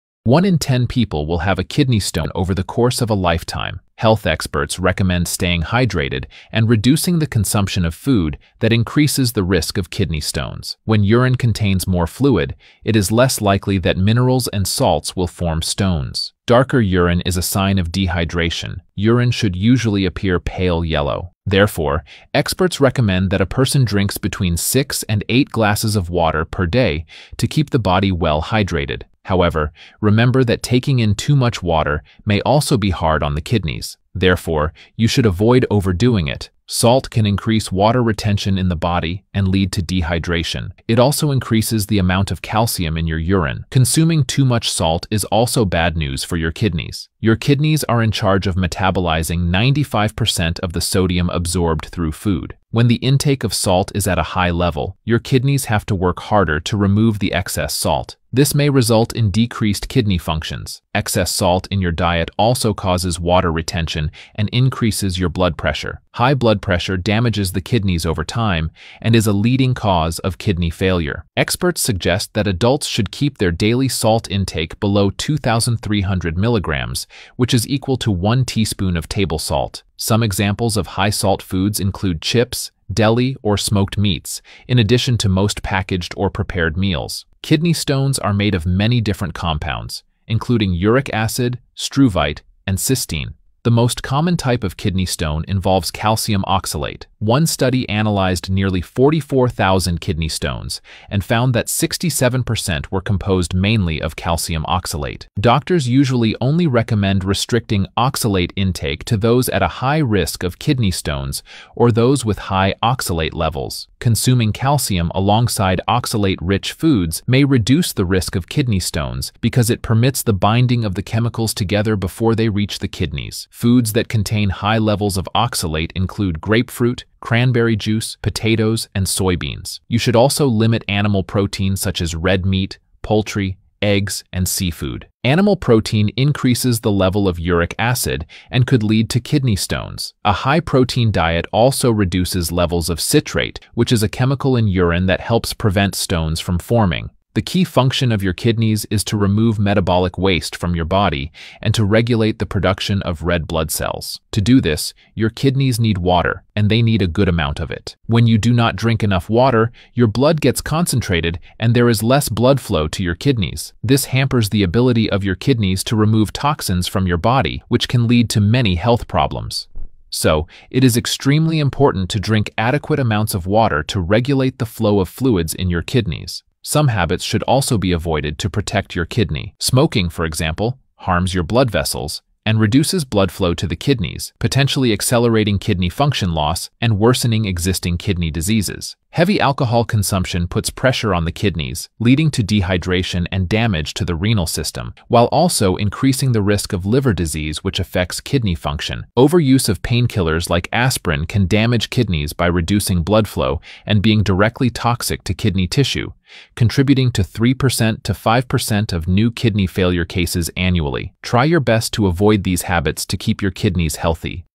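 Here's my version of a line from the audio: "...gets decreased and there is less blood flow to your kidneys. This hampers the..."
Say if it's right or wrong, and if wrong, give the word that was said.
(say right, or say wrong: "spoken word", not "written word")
wrong: "concentrated", not "decreased".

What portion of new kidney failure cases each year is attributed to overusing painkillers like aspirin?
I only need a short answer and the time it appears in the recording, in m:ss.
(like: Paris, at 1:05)
3% to 5%, at 3:27.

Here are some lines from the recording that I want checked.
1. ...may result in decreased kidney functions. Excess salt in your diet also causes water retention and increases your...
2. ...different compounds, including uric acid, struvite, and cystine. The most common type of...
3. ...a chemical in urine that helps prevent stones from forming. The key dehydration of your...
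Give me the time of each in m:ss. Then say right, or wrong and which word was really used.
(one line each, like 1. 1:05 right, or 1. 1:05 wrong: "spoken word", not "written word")
1. 0:58 right
2. 1:29 right
3. 2:24 wrong: "function", not "dehydration".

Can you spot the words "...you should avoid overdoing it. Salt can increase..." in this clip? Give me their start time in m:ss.
0:34.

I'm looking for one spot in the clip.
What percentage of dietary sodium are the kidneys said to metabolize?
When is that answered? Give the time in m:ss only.
0:49.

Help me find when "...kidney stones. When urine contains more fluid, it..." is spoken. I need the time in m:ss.
0:09.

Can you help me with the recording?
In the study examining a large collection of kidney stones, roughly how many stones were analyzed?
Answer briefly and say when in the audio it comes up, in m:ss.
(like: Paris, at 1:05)
44,000, at 1:38.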